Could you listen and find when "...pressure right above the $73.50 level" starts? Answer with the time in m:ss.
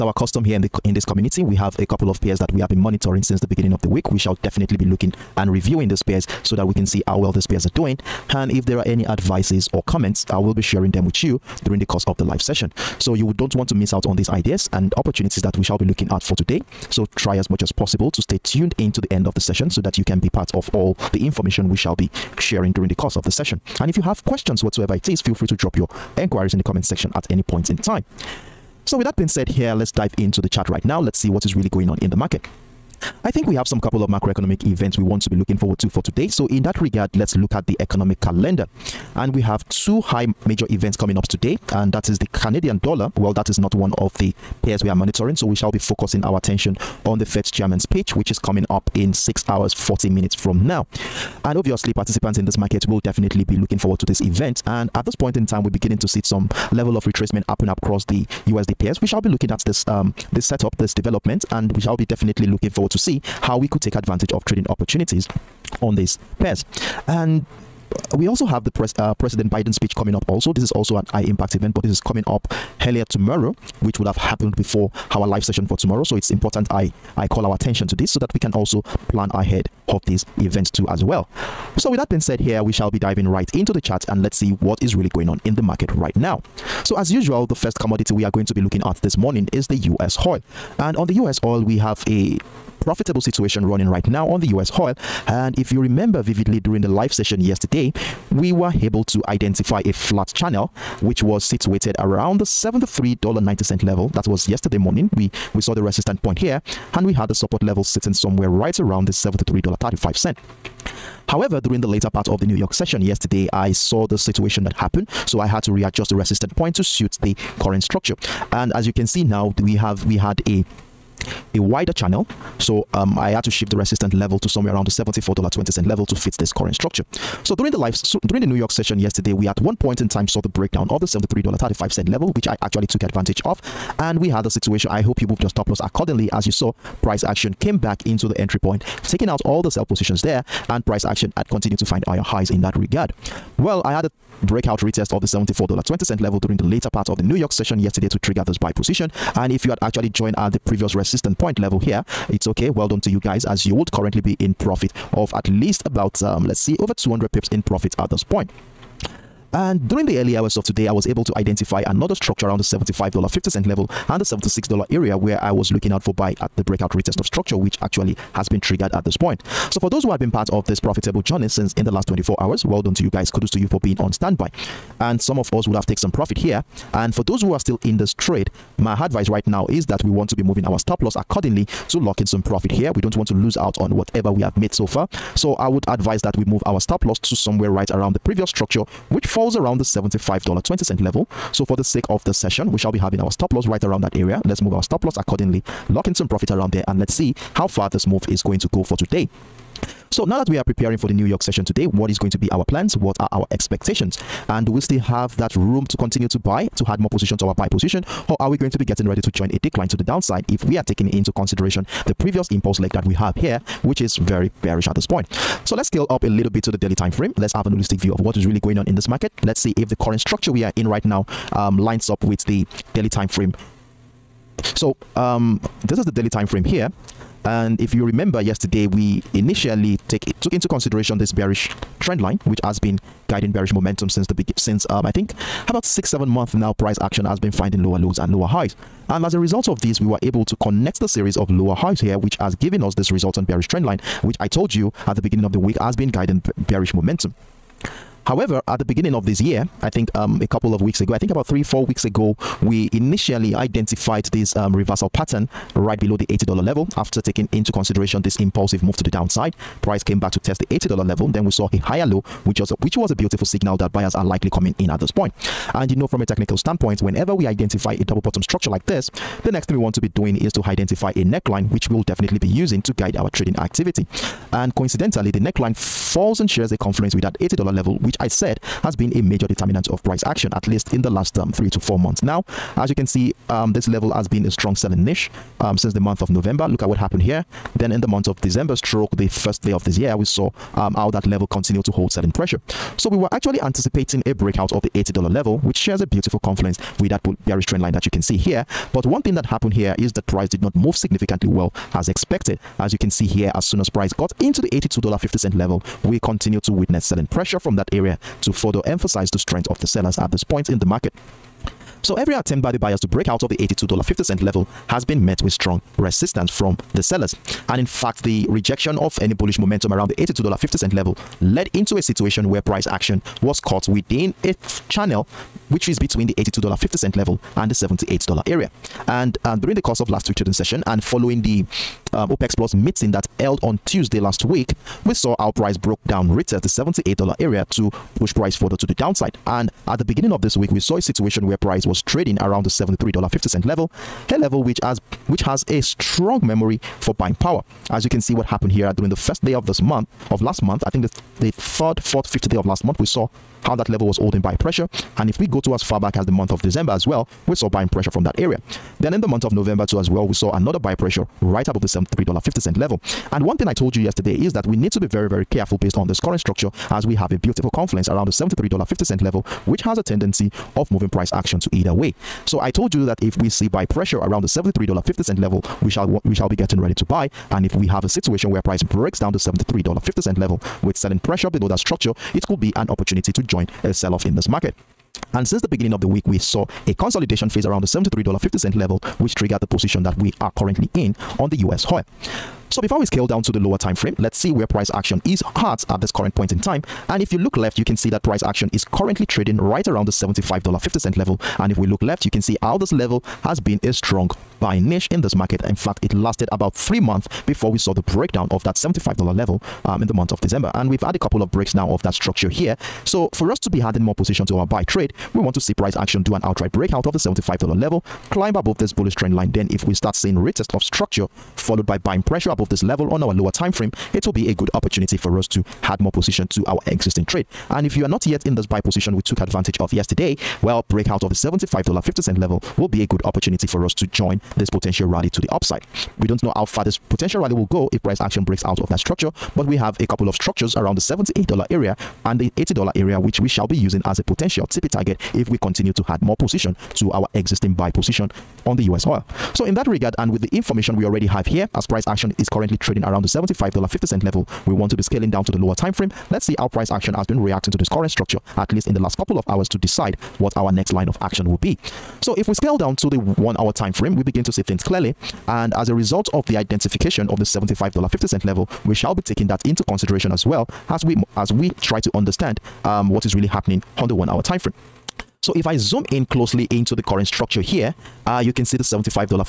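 6:00.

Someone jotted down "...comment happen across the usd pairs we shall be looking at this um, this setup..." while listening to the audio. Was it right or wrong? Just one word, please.
wrong.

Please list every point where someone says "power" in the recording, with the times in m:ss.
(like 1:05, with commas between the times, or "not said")
5:47.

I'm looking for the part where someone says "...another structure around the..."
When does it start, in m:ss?
2:41.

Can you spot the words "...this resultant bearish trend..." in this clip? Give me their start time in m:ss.
4:02.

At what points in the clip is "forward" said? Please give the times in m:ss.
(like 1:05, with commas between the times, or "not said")
0:35, 0:53, 1:02.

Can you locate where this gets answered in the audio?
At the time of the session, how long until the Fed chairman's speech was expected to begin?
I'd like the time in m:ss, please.
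0:49.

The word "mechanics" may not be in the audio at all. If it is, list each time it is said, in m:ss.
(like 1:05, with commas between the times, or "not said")
not said.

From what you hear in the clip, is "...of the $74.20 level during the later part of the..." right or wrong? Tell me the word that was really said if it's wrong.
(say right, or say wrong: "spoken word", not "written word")
right.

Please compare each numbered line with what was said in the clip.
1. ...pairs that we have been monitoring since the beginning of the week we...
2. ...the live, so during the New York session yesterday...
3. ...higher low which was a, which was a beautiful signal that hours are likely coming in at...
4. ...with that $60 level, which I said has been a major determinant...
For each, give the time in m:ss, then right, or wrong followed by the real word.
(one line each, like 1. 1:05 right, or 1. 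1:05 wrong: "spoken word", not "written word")
1. 0:02 right
2. 2:07 right
3. 4:21 wrong: "buyers", not "hours"
4. 4:37 wrong: "80", not "60".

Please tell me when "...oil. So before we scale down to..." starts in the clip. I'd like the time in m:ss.
6:31.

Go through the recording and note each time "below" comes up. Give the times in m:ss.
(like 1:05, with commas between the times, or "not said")
4:15, 6:21.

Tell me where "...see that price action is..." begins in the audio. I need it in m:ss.
6:37.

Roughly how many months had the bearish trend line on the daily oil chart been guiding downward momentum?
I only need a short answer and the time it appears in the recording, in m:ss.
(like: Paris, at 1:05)
6 to 7 months, at 3:55.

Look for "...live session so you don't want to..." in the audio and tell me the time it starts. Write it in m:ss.
0:12.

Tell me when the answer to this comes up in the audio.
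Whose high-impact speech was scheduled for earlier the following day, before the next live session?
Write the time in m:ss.
1:09.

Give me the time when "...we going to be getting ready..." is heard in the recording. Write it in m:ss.
3:28.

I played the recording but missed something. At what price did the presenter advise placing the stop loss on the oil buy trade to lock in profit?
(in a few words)
$75.20.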